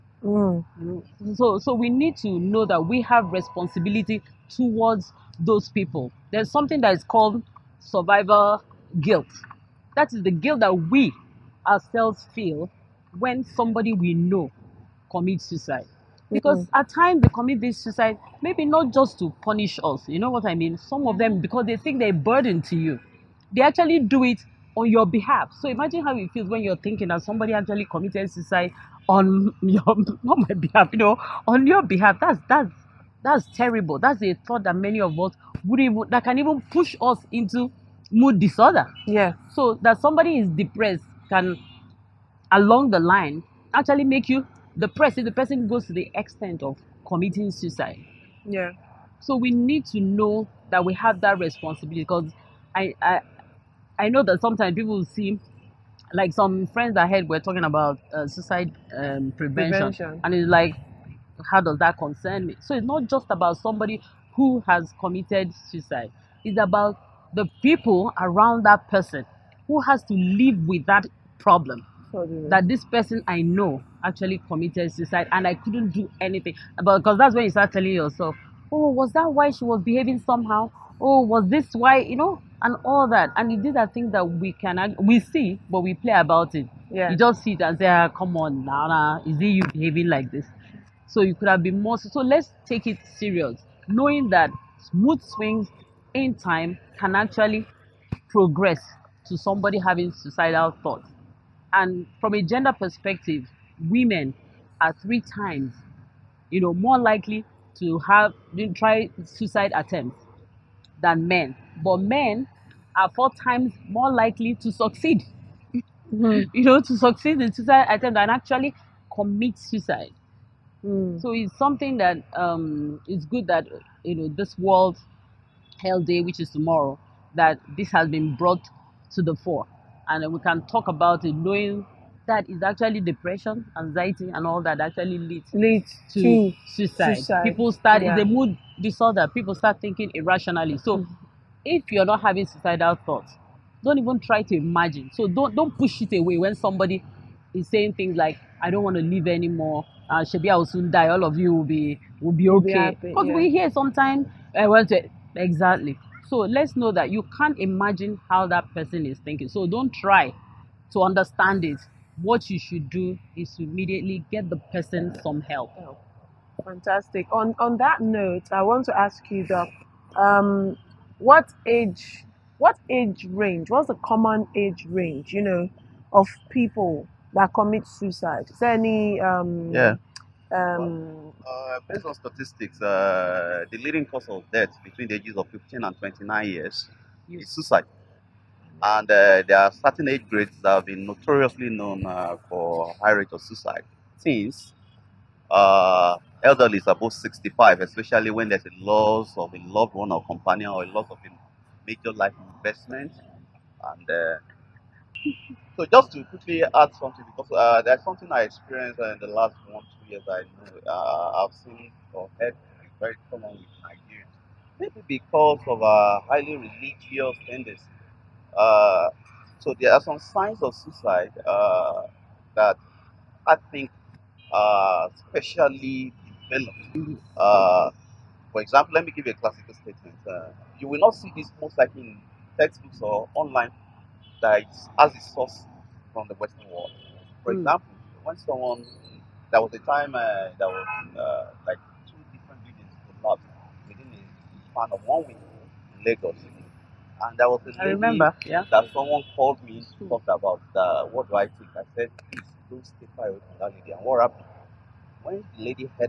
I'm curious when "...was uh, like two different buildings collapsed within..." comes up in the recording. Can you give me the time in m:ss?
4:00.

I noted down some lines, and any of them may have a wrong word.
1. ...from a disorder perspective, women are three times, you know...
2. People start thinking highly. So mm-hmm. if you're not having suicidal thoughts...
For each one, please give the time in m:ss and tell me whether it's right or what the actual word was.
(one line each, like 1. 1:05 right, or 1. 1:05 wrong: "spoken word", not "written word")
1. 1:42 wrong: "gender", not "disorder"
2. 2:19 wrong: "irrationally", not "highly".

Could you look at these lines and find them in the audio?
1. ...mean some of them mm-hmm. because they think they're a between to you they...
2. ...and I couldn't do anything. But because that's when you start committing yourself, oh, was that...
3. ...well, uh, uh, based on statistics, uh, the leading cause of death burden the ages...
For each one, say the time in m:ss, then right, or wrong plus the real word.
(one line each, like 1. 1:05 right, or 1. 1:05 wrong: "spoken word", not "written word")
1. 0:20 wrong: "burden", not "between"
2. 1:15 wrong: "telling", not "committing"
3. 3:01 wrong: "between", not "burden".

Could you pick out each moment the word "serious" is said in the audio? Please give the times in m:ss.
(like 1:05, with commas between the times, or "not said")
1:33.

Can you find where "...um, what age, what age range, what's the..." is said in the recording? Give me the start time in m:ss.
2:50.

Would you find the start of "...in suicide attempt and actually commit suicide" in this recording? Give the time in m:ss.
1:57.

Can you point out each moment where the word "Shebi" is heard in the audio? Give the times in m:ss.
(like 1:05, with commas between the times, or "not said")
2:30.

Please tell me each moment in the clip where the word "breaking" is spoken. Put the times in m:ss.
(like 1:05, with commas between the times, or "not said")
not said.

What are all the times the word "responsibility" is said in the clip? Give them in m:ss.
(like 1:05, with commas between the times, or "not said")
0:03, 0:51.